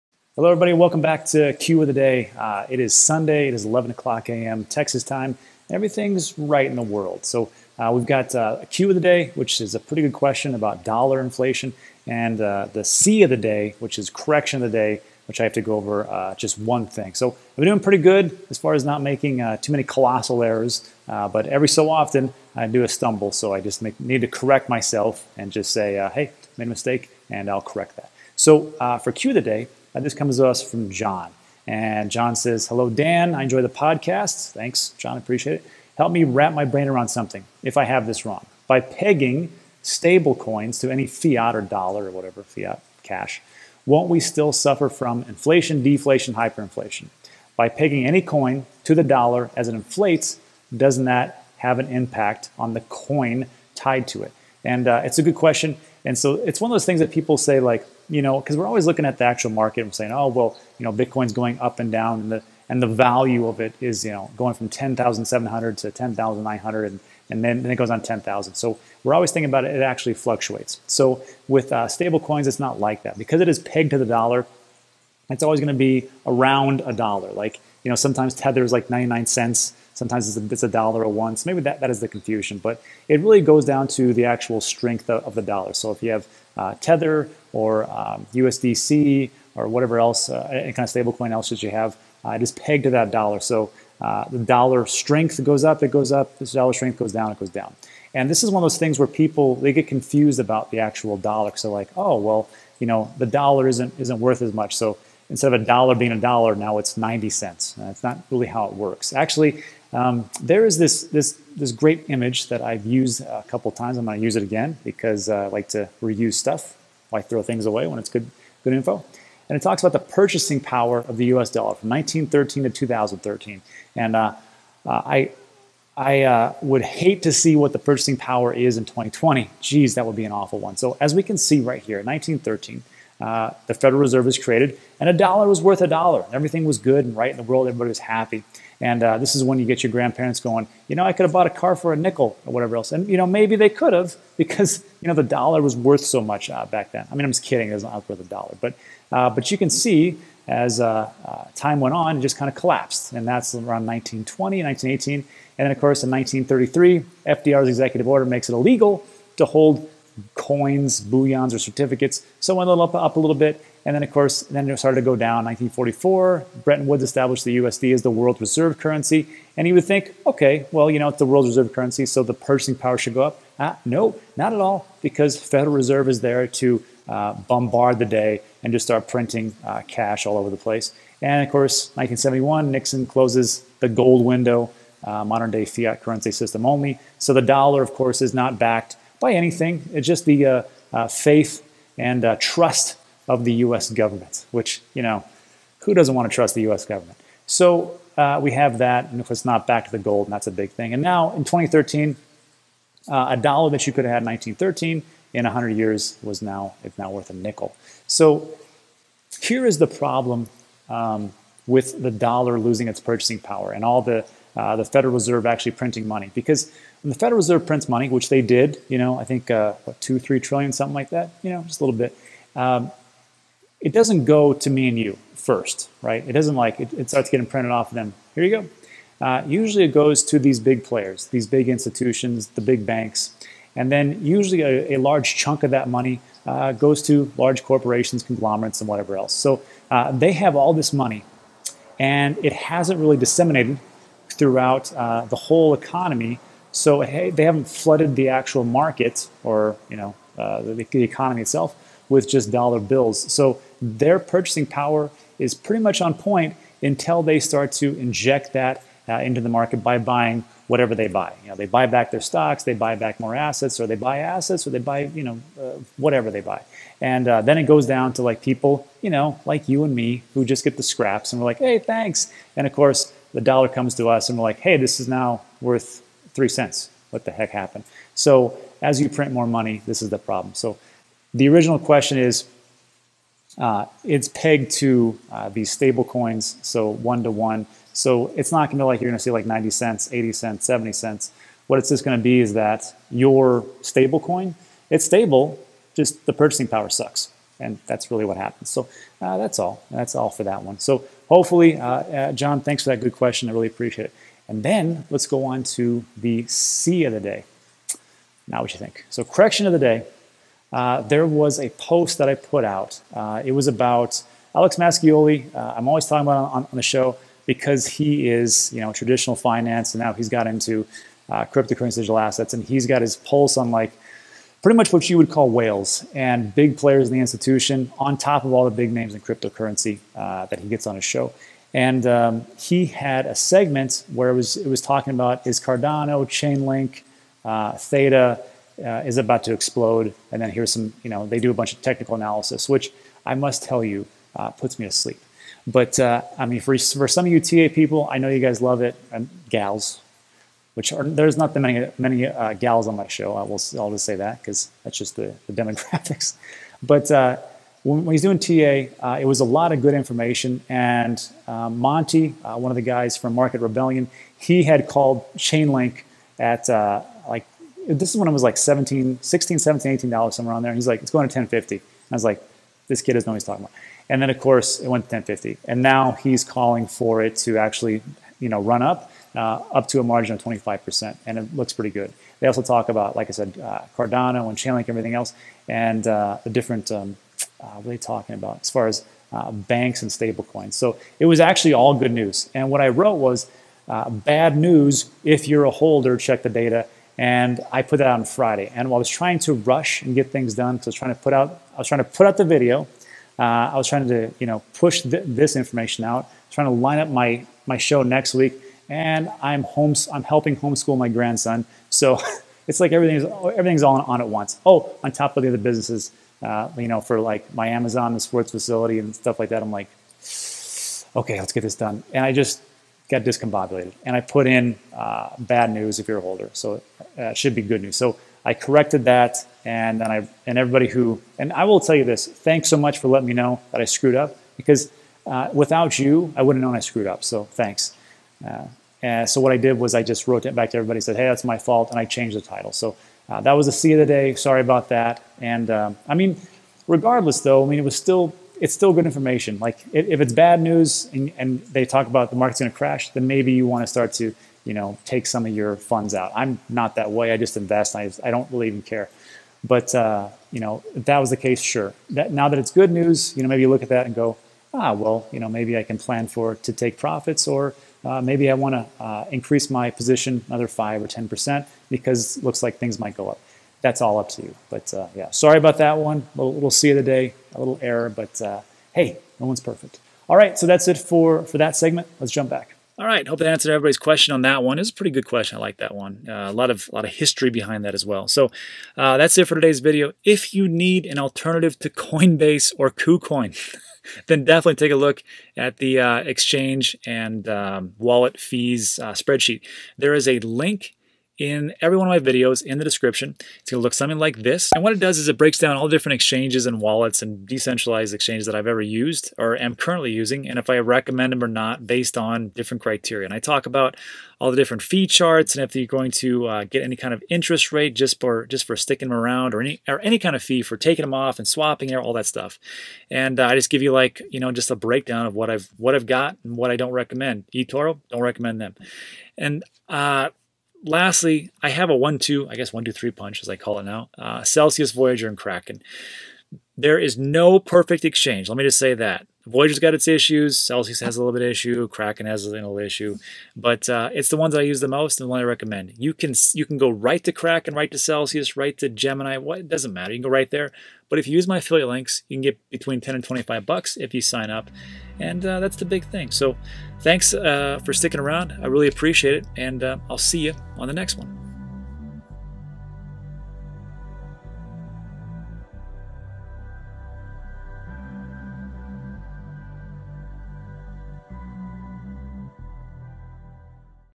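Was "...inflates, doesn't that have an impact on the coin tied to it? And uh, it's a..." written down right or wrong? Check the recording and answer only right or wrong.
right.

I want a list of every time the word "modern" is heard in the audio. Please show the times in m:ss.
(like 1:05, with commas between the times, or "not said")
3:05.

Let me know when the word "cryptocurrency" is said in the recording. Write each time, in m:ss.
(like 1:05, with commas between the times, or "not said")
5:21, 5:29.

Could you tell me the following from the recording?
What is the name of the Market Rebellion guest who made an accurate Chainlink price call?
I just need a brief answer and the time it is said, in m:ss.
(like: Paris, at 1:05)
Monty, at 6:01.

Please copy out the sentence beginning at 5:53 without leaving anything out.
I will I'll just say that because that's just the, the demographics.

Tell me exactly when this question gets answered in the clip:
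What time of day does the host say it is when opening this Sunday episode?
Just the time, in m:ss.
0:03.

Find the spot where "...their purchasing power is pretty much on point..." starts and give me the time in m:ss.
4:13.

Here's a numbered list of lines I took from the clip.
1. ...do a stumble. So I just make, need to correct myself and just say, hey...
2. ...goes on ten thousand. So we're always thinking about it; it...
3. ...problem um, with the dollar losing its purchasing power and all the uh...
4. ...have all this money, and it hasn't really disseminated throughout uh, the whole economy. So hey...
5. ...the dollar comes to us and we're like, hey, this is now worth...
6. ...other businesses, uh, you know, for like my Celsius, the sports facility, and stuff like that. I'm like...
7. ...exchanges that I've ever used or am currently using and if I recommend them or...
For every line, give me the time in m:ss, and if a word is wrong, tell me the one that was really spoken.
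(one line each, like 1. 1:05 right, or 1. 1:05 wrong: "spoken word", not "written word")
1. 0:22 right
2. 1:07 right
3. 3:29 right
4. 4:00 right
5. 4:33 right
6. 6:55 wrong: "Amazon", not "Celsius"
7. 8:28 right.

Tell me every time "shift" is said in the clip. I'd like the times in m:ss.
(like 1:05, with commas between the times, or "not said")
not said.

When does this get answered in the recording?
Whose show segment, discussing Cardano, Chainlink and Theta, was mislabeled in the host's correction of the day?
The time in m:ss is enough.
5:14.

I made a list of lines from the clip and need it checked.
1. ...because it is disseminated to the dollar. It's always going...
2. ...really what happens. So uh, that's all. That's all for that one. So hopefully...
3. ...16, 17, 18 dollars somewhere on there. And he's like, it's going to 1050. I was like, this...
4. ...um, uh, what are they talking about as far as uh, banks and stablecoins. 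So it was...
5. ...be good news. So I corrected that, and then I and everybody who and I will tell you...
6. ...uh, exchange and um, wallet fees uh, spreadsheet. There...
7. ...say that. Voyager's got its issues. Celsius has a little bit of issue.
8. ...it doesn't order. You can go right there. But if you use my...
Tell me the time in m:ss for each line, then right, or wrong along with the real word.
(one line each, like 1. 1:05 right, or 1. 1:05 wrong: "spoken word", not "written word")
1. 1:13 wrong: "pegged", not "disseminated"
2. 4:58 right
3. 6:09 right
4. 6:26 right
5. 7:07 right
6. 8:15 right
7. 8:58 right
8. 9:09 wrong: "matter", not "order".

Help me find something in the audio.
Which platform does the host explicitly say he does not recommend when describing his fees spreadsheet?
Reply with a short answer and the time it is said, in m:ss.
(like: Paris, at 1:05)
eToro, at 8:47.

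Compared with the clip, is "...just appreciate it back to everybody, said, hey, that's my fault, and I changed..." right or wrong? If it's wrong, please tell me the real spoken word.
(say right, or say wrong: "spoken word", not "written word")
wrong: "wrote", not "appreciate".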